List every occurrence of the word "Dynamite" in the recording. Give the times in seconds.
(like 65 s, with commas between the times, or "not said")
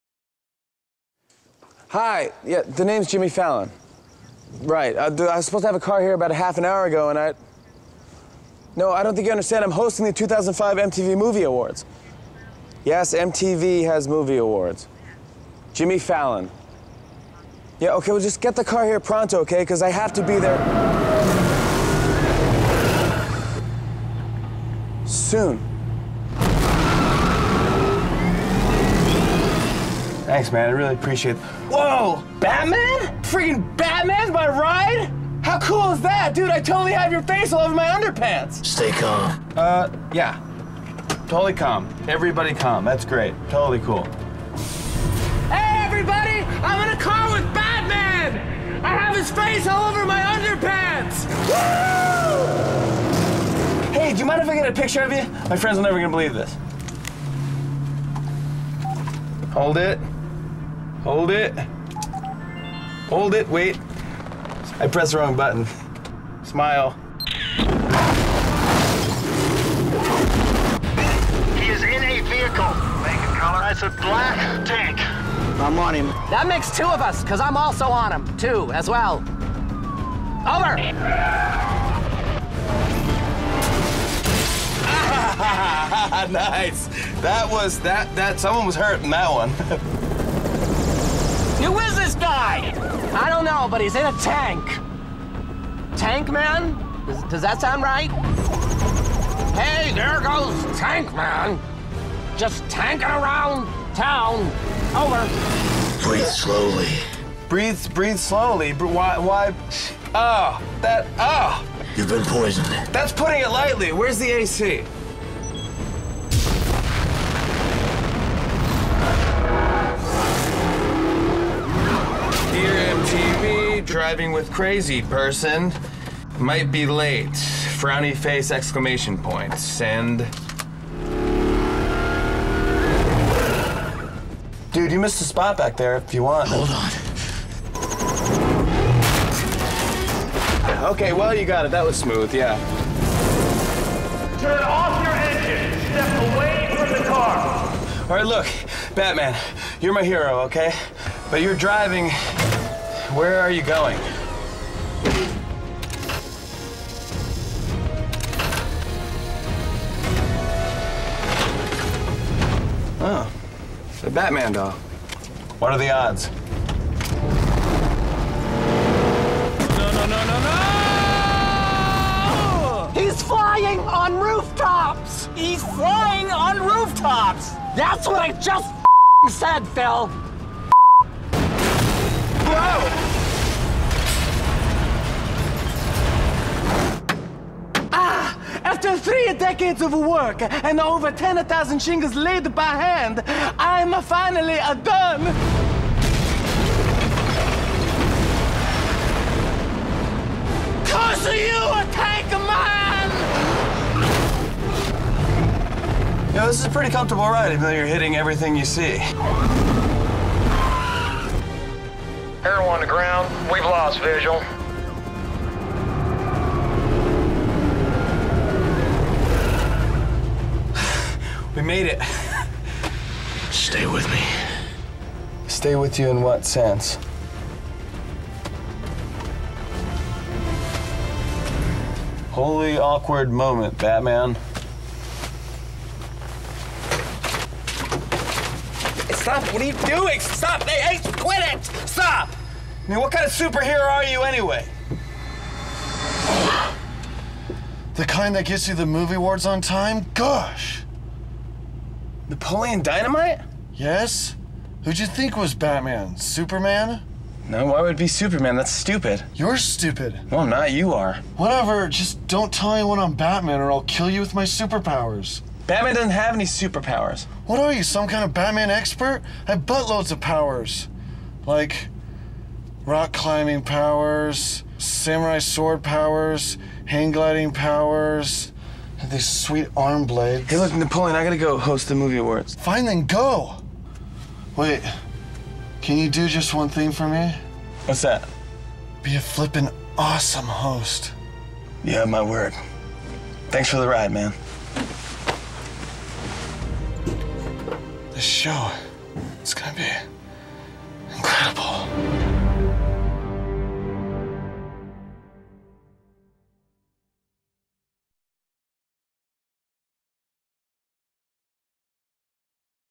252 s.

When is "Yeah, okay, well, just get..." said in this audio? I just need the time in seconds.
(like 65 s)
17 s.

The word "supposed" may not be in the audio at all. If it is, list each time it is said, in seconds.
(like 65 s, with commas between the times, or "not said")
5 s.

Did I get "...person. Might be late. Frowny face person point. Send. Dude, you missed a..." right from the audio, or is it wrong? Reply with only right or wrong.
wrong.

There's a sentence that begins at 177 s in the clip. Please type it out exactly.
That's what I just said, Phil!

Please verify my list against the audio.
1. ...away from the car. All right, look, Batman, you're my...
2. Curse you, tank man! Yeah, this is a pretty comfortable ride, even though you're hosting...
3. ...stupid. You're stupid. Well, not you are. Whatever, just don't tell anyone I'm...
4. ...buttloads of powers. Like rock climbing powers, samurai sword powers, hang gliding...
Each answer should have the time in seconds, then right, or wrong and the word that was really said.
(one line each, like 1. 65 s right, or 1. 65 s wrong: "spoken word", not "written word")
1. 146 s right
2. 200 s wrong: "hitting", not "hosting"
3. 258 s right
4. 269 s right.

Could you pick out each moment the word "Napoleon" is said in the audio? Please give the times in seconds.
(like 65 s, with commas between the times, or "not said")
252 s, 280 s.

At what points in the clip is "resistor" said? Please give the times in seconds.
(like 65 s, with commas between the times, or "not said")
not said.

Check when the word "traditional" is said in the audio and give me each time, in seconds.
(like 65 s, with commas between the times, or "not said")
not said.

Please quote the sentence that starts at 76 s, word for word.
That makes two of us, because I'm also on him, too, as well.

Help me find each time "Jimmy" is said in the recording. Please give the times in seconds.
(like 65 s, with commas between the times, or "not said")
3 s, 15 s.